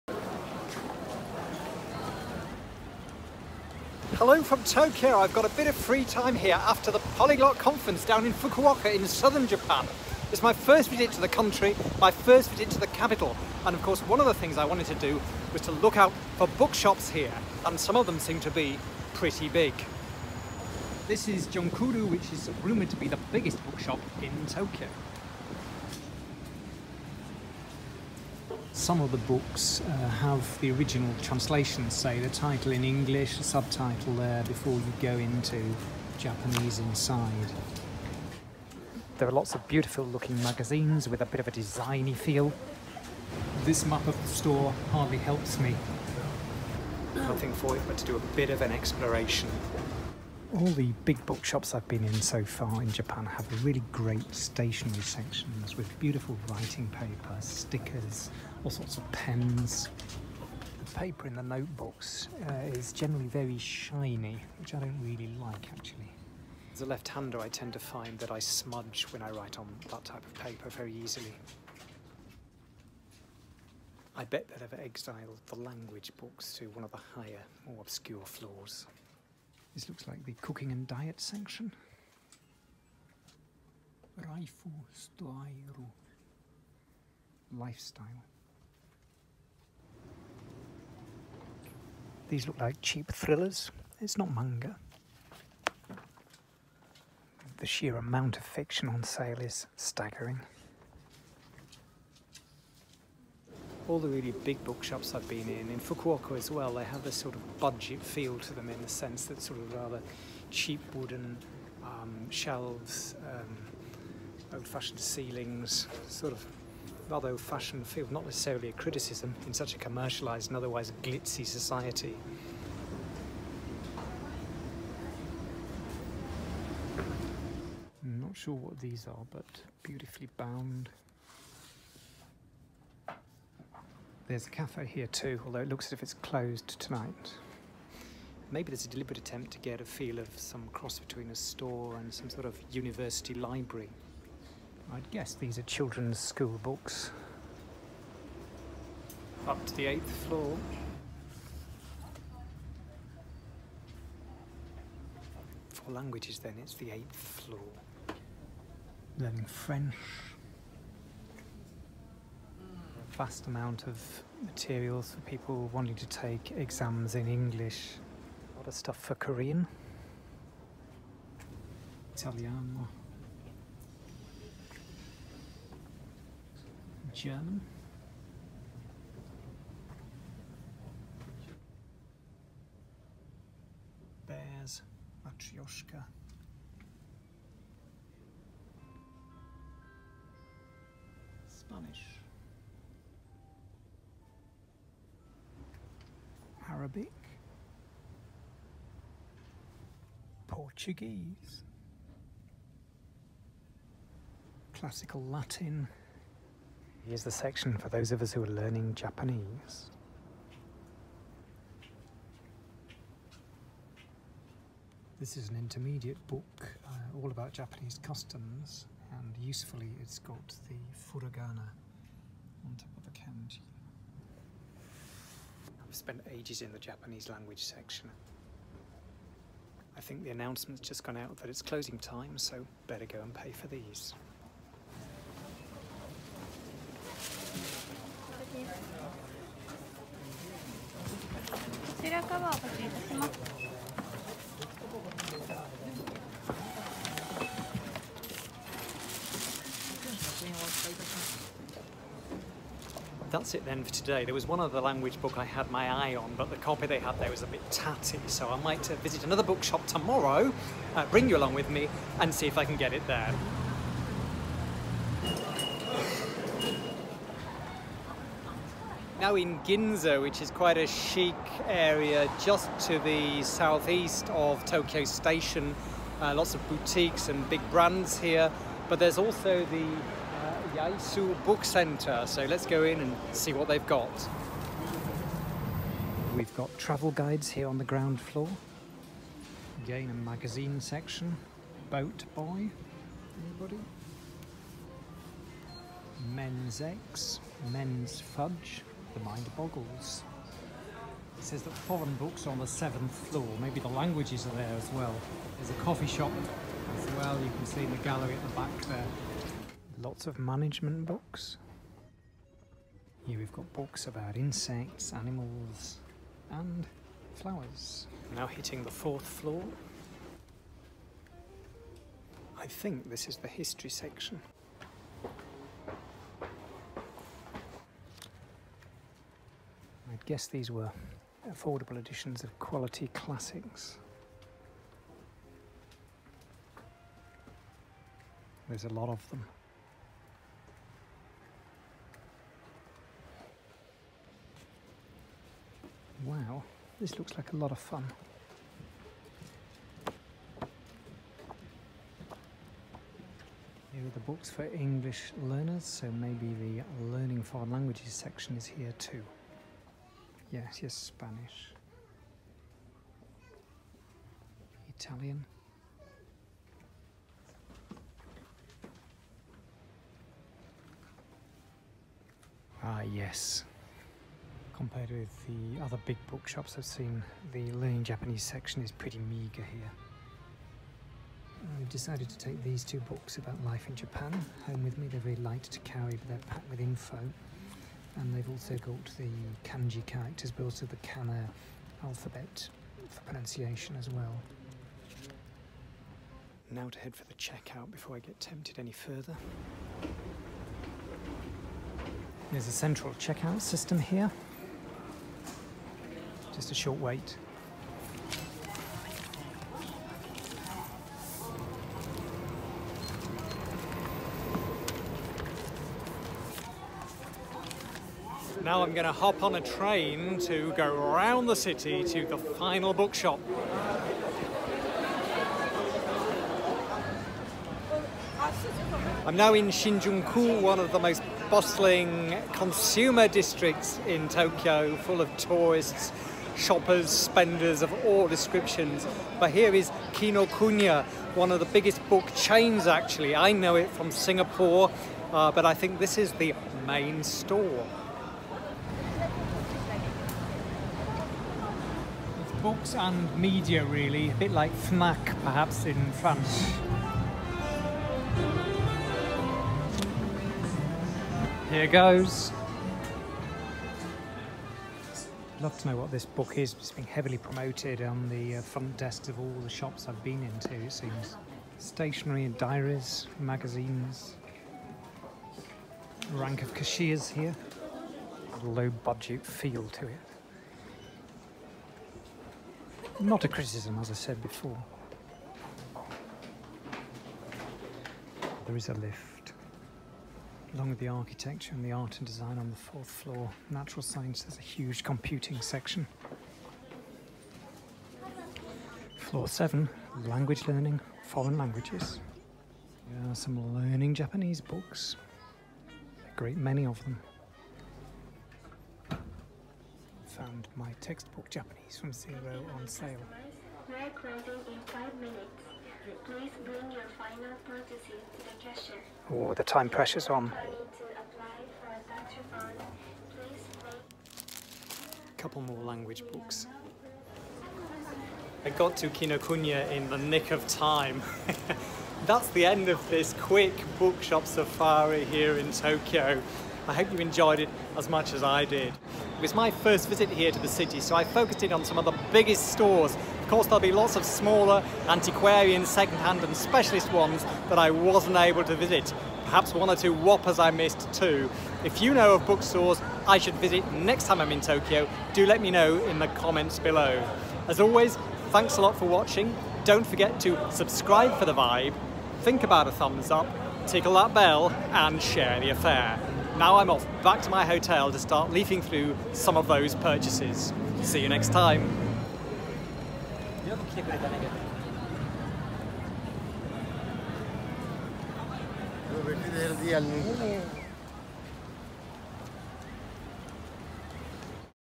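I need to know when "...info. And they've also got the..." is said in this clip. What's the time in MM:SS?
06:26.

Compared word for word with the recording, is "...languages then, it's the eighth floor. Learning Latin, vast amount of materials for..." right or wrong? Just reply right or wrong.
wrong.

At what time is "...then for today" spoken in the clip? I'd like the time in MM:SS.
04:13.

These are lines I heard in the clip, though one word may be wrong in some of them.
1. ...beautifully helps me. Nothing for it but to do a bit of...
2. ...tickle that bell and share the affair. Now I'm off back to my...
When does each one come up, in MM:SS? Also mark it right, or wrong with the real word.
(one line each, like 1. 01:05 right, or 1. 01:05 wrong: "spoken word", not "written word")
1. 00:44 wrong: "hardly", not "beautifully"
2. 09:23 right.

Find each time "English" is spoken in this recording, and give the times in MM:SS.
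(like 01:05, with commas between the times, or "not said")
00:32, 02:47, 05:54.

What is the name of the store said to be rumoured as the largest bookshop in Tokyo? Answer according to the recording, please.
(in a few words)
Junkudo.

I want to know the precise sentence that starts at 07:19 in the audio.
But here is Kinokuniya, one of the biggest book chains actually.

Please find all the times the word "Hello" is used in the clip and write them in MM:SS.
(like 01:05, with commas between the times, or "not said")
00:04.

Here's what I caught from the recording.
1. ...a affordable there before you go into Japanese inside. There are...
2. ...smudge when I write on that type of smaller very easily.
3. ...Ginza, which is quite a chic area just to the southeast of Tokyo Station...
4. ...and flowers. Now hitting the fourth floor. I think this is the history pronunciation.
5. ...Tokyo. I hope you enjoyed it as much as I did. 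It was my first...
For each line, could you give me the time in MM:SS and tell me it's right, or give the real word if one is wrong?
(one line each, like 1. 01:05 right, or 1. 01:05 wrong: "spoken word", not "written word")
1. 00:33 wrong: "subtitle", not "affordable"
2. 01:08 wrong: "paper", not "smaller"
3. 04:29 right
4. 05:16 wrong: "section", not "pronunciation"
5. 08:55 right.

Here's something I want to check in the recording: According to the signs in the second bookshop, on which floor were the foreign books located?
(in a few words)
7th floor.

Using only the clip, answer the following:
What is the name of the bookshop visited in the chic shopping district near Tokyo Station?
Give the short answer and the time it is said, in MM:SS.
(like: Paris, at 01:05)
Yaesu Book Center, at 04:40.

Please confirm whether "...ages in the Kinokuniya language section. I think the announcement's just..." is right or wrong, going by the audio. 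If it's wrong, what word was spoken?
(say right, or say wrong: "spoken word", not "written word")
wrong: "Japanese", not "Kinokuniya".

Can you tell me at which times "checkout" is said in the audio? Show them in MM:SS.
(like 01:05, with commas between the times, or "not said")
06:37, 06:43.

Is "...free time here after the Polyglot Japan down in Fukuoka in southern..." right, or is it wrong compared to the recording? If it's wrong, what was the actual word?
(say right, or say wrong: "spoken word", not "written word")
wrong: "Conference", not "Japan".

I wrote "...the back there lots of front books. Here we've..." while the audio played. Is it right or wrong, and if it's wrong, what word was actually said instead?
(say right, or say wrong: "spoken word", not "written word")
wrong: "management", not "front".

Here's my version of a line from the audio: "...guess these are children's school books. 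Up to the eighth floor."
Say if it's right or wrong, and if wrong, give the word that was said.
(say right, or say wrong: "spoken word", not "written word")
right.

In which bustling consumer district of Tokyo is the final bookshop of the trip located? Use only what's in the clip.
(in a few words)
Shinjuku.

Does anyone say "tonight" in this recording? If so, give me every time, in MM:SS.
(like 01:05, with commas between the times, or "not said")
02:16.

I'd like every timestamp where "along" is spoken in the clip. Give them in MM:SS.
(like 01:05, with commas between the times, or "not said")
04:21, 08:10.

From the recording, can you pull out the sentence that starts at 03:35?
This is an intermediate book uh, all about Japanese customs and usefully it's got the furigana on top of the kanji.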